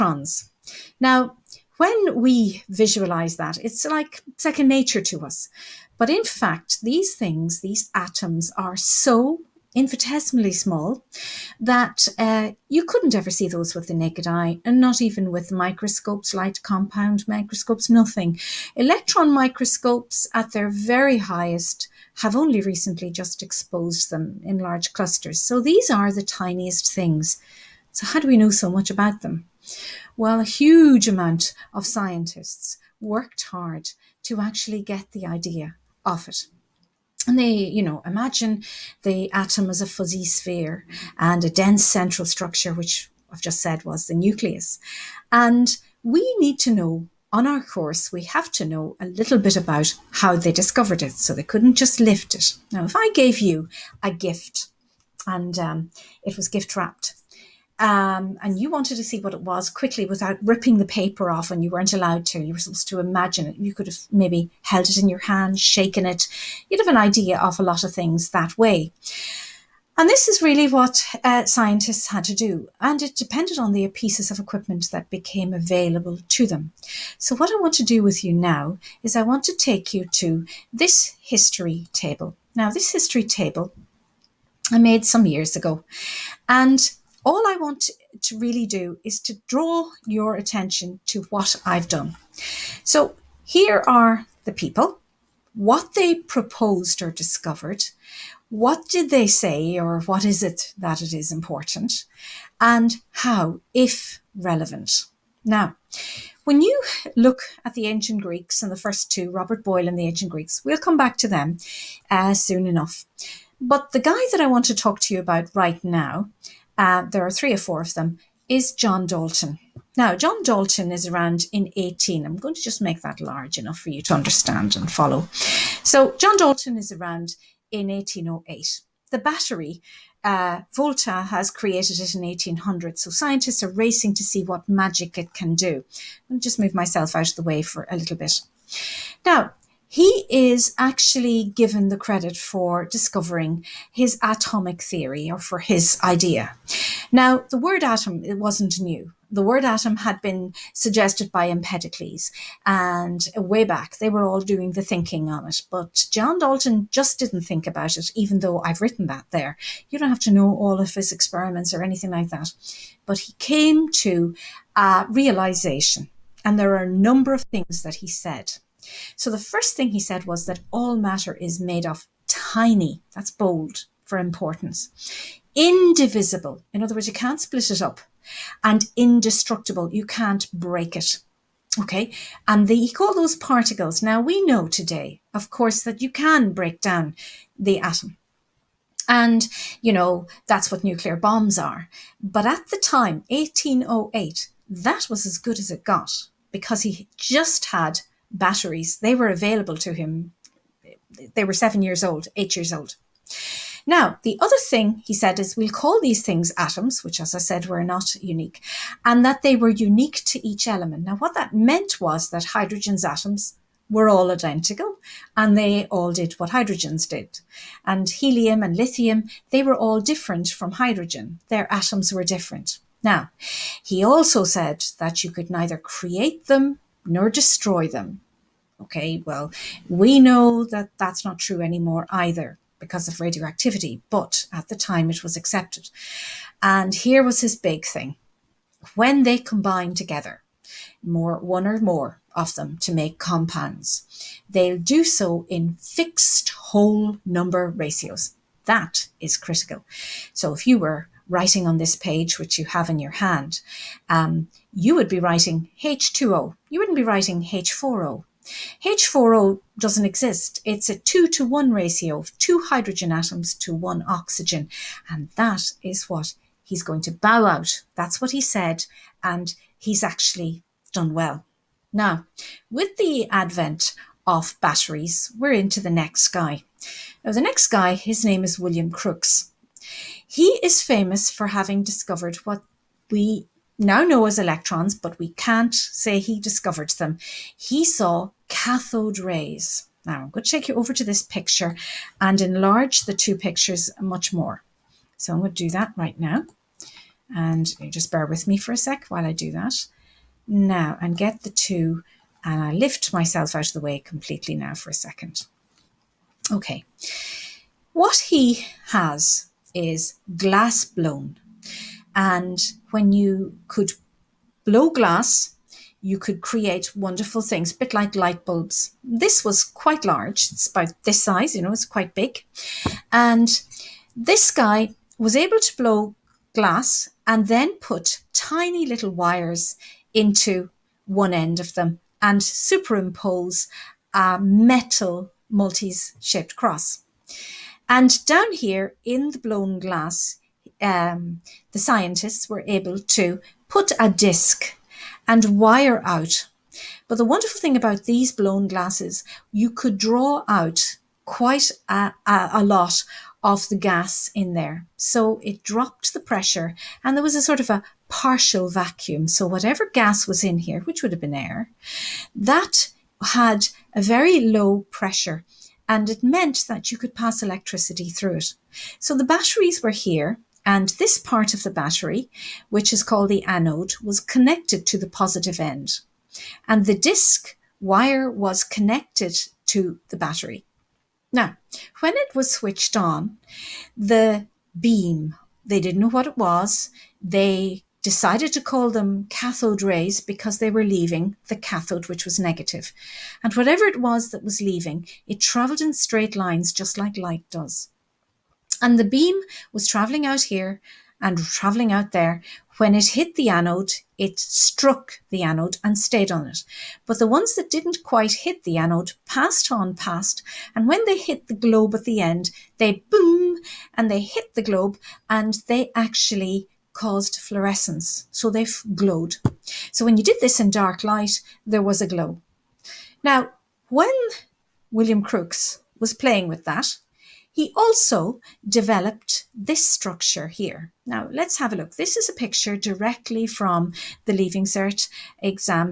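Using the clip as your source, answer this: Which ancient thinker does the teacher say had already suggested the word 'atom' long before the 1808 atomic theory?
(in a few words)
Empedocles.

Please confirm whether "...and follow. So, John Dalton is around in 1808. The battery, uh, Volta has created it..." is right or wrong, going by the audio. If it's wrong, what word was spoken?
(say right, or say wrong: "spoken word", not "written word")
right.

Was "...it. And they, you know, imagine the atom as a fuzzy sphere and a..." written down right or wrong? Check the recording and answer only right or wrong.
right.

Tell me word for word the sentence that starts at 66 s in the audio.
You'd have an idea of a lot of things that way.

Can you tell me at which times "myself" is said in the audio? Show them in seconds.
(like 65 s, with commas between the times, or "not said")
136 s, 303 s.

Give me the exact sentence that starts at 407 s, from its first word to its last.
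But the ones that didn't quite hit the anode passed on past.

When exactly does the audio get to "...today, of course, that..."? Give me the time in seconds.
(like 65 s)
184 s.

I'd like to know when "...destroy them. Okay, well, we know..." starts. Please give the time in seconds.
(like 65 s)
227 s.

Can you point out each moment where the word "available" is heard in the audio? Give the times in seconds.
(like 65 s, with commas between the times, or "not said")
75 s, 199 s.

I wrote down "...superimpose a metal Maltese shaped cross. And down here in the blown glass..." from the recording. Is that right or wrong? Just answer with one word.
right.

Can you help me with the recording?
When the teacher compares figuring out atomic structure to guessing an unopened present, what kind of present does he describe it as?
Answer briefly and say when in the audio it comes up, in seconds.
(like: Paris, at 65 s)
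gift wrapped, at 56 s.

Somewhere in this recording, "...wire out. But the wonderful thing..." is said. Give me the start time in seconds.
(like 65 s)
345 s.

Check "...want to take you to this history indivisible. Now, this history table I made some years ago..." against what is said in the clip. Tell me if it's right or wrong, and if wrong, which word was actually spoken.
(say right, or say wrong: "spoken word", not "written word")
wrong: "table", not "indivisible".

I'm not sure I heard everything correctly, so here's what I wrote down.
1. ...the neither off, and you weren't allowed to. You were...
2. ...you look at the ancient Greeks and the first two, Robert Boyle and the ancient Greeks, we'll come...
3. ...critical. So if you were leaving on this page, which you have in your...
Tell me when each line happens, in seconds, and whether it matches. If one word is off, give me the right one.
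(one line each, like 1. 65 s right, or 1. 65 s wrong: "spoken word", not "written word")
1. 60 s wrong: "paper", not "neither"
2. 106 s right
3. 249 s wrong: "writing", not "leaving".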